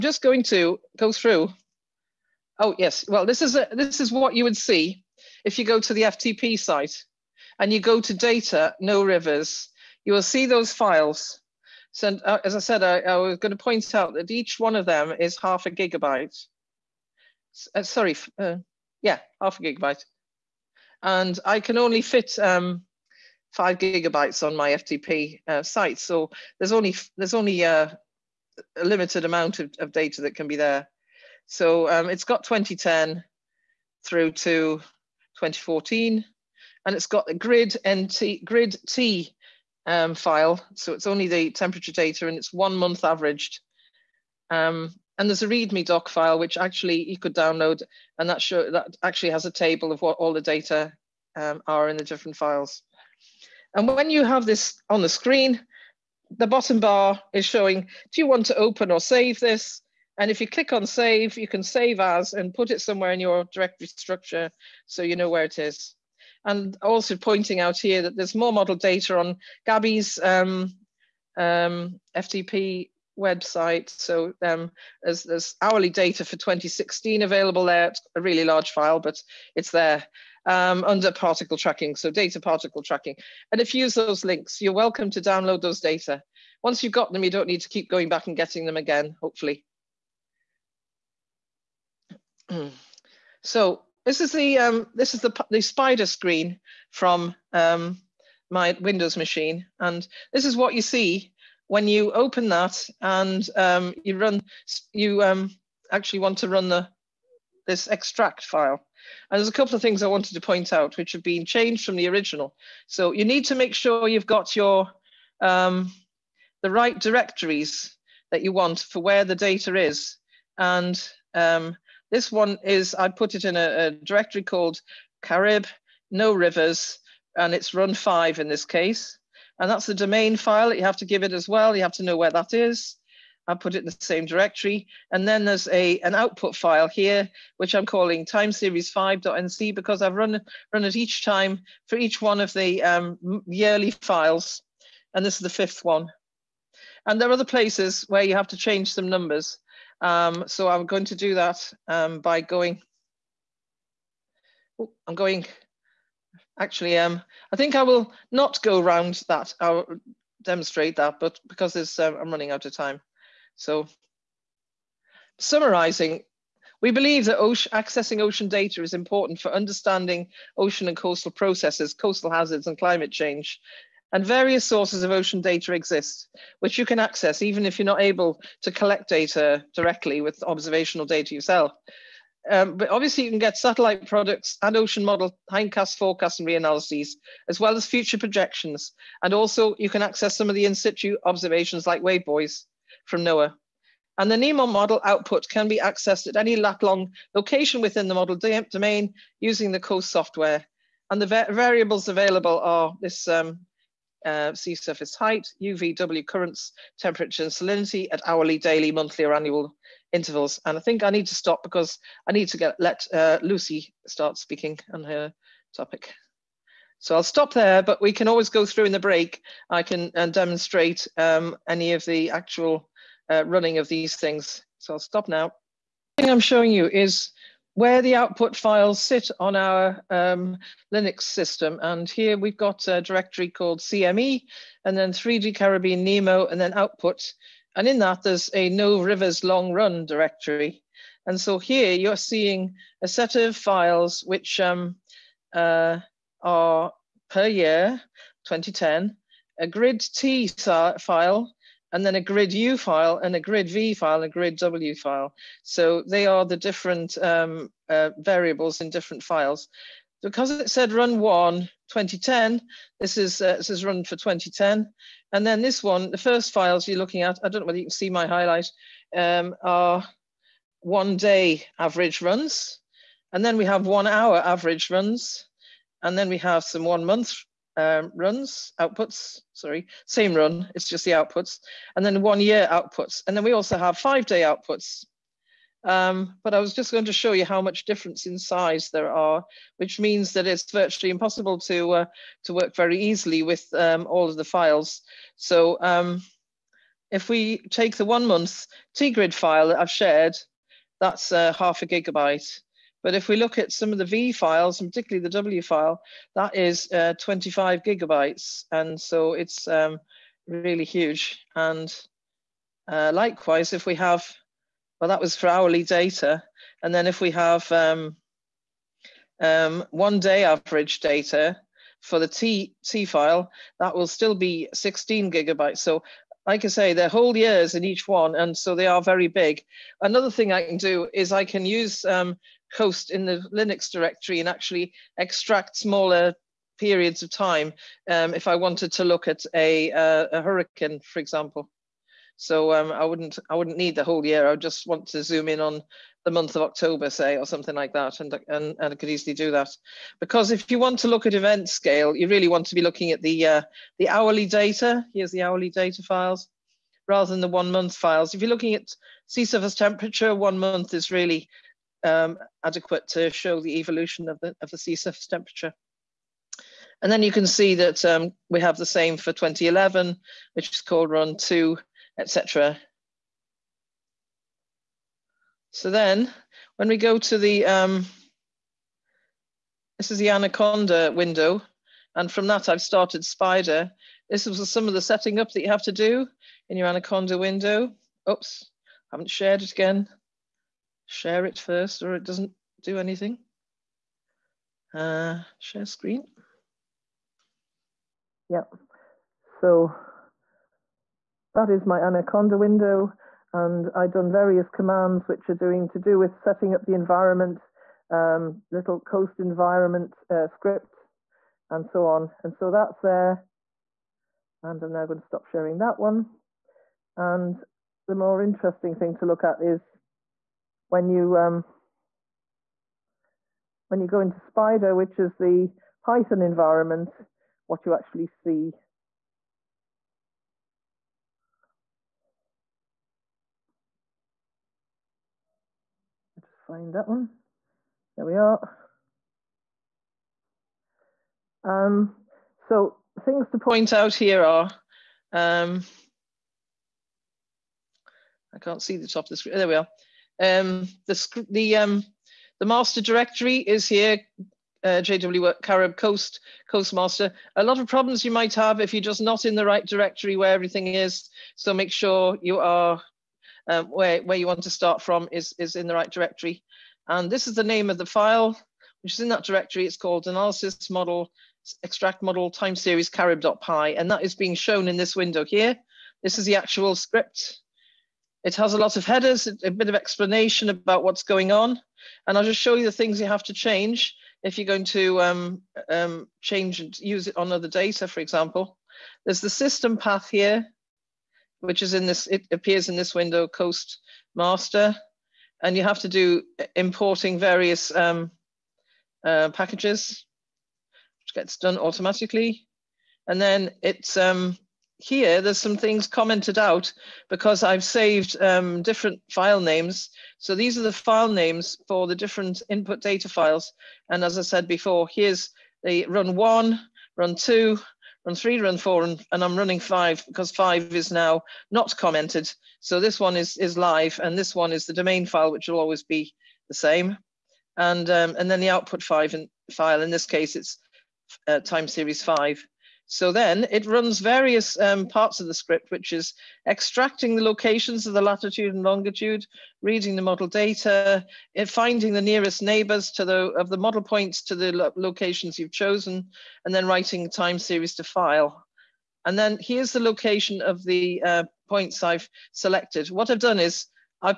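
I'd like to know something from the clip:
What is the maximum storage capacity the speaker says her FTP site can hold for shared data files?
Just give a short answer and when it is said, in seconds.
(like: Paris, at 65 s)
5 gigabytes, at 23 s.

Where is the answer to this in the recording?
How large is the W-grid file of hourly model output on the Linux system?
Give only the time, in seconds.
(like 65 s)
307 s.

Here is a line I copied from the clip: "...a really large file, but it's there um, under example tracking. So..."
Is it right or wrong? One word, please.
wrong.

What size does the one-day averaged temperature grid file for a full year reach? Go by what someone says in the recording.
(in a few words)
16 gigabytes.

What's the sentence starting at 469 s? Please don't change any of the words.
It's called analysis model extract model time series carib.py, and that is being shown in this window here.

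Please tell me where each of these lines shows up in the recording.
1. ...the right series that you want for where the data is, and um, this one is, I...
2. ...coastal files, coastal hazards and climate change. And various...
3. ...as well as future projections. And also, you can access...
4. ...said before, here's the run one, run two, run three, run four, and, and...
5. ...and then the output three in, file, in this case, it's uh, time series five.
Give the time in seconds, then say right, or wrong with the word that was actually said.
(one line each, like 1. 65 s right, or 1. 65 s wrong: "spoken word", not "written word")
1. 116 s wrong: "directories", not "series"
2. 170 s wrong: "processes", not "files"
3. 187 s right
4. 514 s right
5. 528 s wrong: "five", not "three".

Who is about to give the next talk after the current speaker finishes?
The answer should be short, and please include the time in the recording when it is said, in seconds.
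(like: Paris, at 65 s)
Lucy, at 213 s.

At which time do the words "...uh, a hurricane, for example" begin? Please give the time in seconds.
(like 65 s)
339 s.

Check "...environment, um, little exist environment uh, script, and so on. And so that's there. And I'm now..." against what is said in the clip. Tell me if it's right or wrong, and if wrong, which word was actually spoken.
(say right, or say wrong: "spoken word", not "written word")
wrong: "coast", not "exist".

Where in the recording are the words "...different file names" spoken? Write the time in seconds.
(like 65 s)
508 s.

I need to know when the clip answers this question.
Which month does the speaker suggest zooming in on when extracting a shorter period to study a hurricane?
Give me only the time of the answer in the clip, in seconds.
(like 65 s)
346 s.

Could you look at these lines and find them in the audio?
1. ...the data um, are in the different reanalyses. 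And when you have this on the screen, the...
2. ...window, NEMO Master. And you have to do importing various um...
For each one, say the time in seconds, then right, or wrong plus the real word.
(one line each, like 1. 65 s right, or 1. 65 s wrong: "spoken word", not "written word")
1. 50 s wrong: "files", not "reanalyses"
2. 493 s wrong: "Coast", not "NEMO".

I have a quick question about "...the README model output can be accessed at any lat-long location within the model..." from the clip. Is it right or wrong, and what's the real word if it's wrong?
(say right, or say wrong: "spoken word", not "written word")
wrong: "NEMO", not "README".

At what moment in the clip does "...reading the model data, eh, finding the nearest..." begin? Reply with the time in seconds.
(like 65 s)
539 s.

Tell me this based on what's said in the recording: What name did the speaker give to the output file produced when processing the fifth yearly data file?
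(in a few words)
time series 5.nc.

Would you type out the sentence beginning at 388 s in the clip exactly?
Oops, haven't shared it again share it first or it doesn't do anything.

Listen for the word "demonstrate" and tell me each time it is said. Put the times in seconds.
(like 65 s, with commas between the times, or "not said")
160 s, 220 s.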